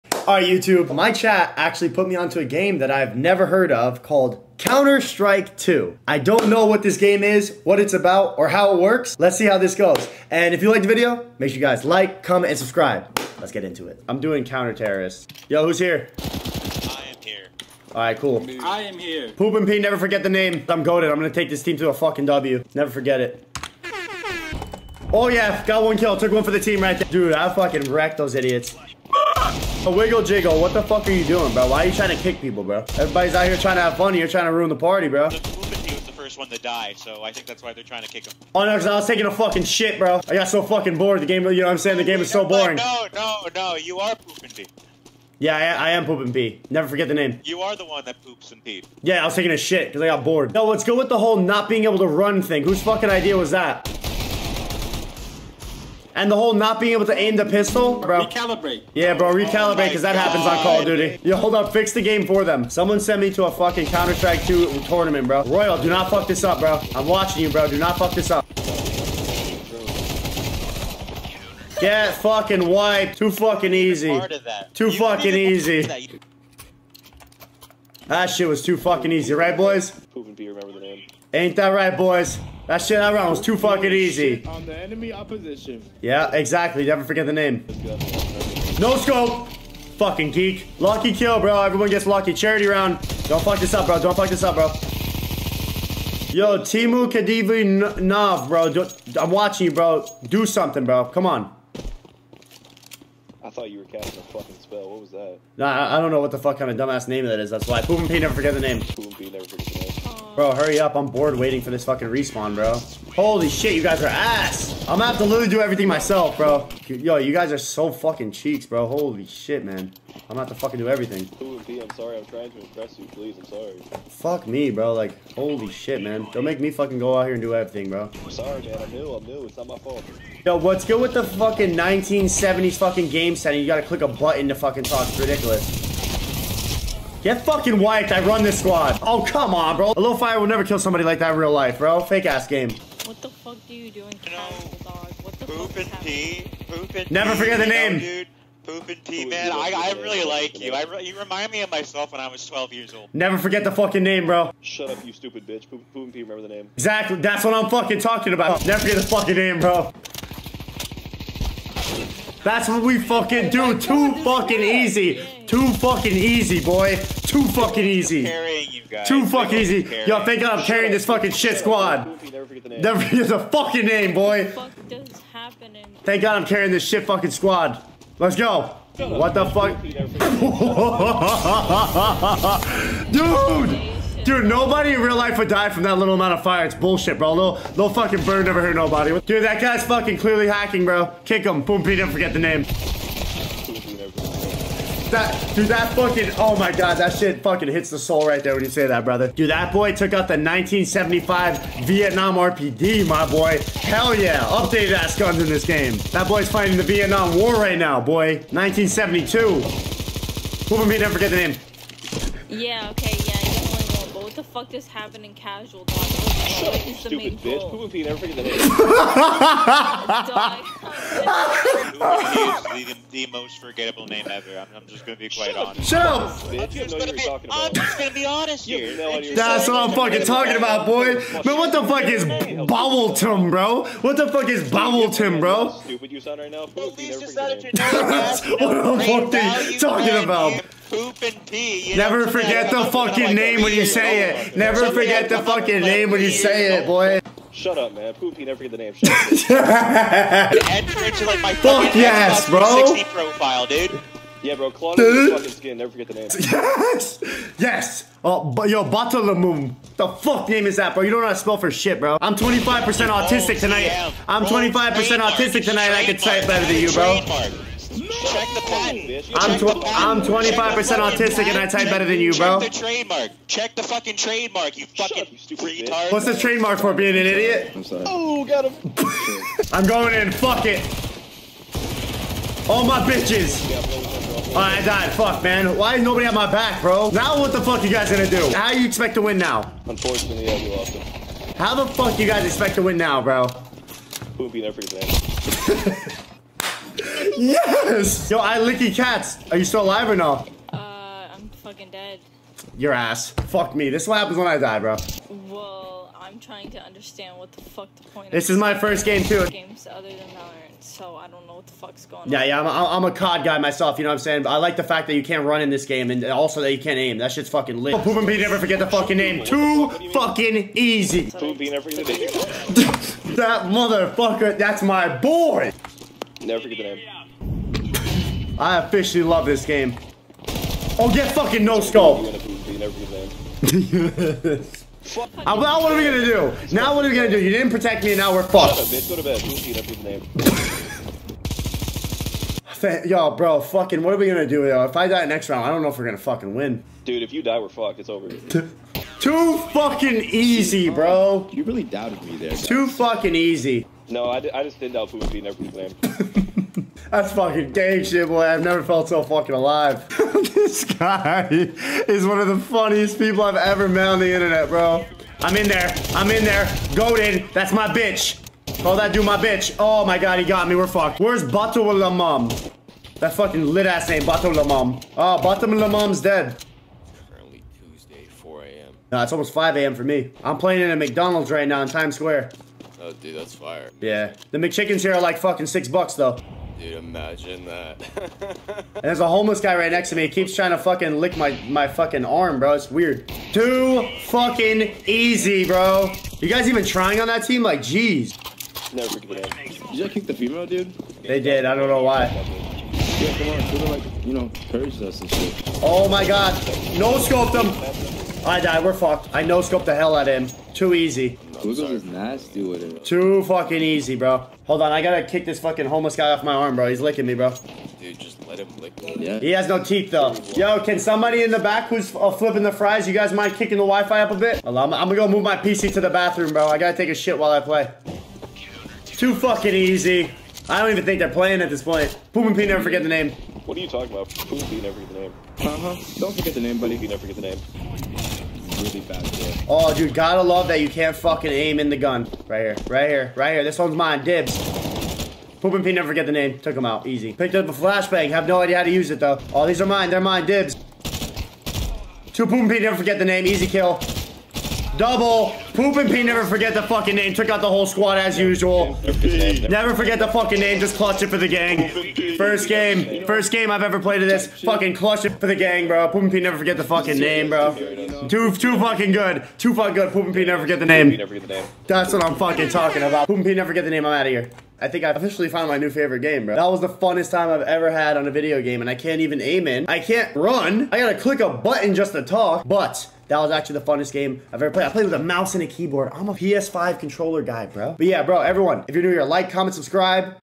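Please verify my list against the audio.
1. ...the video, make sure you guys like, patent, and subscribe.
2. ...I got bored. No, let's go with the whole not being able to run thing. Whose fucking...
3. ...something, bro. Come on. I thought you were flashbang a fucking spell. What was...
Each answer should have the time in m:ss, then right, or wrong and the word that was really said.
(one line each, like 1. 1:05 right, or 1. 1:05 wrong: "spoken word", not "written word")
1. 0:10 wrong: "comment", not "patent"
2. 0:50 right
3. 1:40 wrong: "casting", not "flashbang".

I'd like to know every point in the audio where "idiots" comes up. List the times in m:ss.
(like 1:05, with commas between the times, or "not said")
0:28, 4:37.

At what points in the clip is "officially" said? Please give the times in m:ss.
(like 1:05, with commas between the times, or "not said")
5:28, 7:55.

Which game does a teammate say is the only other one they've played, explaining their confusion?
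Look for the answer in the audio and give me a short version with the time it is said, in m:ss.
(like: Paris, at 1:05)
Valorant, at 5:10.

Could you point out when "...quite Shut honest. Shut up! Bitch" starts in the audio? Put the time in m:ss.
3:45.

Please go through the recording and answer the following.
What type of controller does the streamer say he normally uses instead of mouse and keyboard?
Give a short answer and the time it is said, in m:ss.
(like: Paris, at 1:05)
PS5 controller, at 8:06.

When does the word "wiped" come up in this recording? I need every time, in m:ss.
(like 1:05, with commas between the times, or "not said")
1:12, 2:17.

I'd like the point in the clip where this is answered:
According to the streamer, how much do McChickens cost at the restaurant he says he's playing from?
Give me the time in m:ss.
6:25.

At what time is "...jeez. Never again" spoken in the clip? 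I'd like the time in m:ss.
6:37.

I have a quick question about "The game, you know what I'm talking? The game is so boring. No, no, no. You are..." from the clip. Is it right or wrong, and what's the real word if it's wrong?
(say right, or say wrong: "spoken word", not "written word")
wrong: "saying", not "talking".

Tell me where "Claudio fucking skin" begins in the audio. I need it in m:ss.
4:14.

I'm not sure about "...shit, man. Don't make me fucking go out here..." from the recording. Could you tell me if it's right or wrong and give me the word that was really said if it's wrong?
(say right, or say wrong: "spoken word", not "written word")
right.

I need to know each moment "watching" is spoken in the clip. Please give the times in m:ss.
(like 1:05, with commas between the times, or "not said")
1:07, 1:39.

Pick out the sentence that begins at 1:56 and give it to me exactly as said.
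Yo, you guys are so fucking cheeks, bro.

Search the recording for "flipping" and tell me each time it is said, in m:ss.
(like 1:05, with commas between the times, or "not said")
7:02.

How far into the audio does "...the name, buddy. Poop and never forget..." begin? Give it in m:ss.
7:16.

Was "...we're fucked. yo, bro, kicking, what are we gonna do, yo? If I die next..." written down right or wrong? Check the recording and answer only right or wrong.
wrong.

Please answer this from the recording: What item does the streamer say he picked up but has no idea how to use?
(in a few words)
Flashbang.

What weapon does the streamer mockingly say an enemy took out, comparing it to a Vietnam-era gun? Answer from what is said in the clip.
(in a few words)
RPD.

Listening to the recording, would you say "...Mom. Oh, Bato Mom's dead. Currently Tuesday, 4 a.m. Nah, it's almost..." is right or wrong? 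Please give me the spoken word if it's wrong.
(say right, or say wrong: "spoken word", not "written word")
right.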